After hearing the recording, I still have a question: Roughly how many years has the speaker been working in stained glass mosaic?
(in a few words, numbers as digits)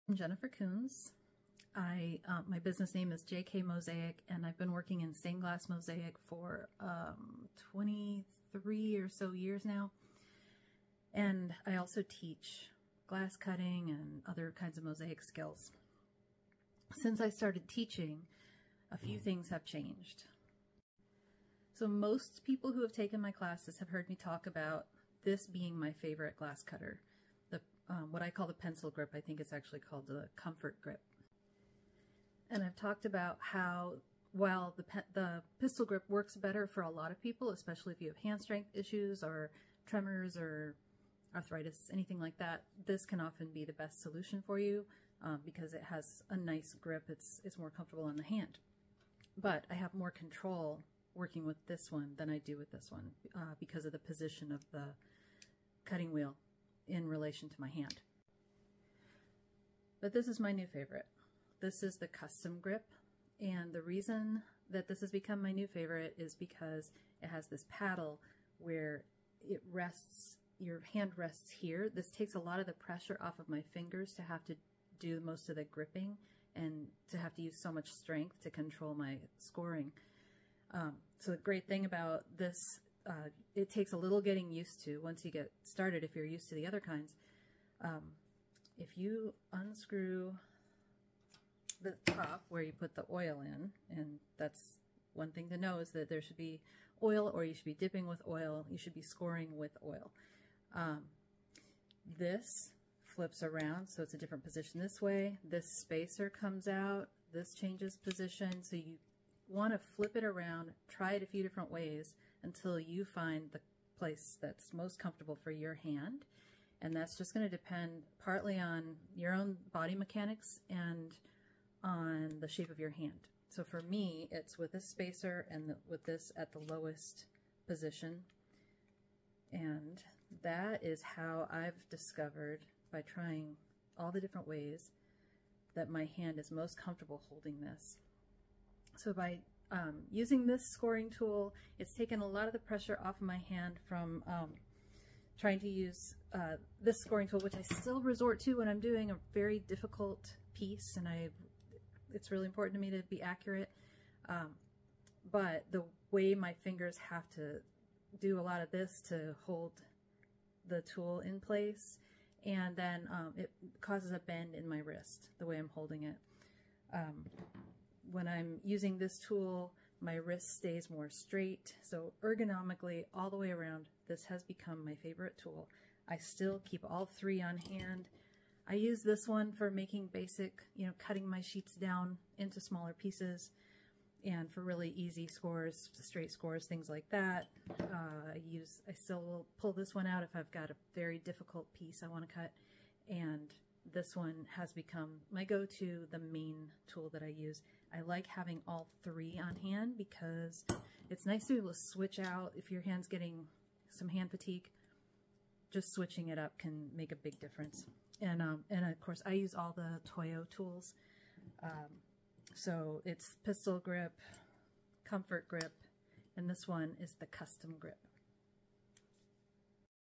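23.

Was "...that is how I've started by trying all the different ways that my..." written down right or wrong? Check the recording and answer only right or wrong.
wrong.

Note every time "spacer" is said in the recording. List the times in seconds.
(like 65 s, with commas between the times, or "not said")
105 s, 124 s.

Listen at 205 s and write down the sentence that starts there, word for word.
Just switching it up can make a big difference.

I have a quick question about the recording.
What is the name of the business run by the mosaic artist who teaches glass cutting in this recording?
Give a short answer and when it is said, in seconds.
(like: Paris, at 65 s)
JK Mosaic, at 3 s.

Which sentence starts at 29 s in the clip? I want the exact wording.
I think it's actually called the comfort grip.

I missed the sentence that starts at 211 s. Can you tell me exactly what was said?
Um, so it's pistol grip, comfort grip, and this one is the custom grip.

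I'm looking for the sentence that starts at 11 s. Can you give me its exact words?
And I also teach glass cutting and other kinds of mosaic skills.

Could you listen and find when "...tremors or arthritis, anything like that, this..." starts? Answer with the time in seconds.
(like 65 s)
39 s.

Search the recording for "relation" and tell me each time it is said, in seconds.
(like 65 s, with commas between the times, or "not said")
57 s.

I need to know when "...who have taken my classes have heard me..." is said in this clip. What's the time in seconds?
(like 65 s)
22 s.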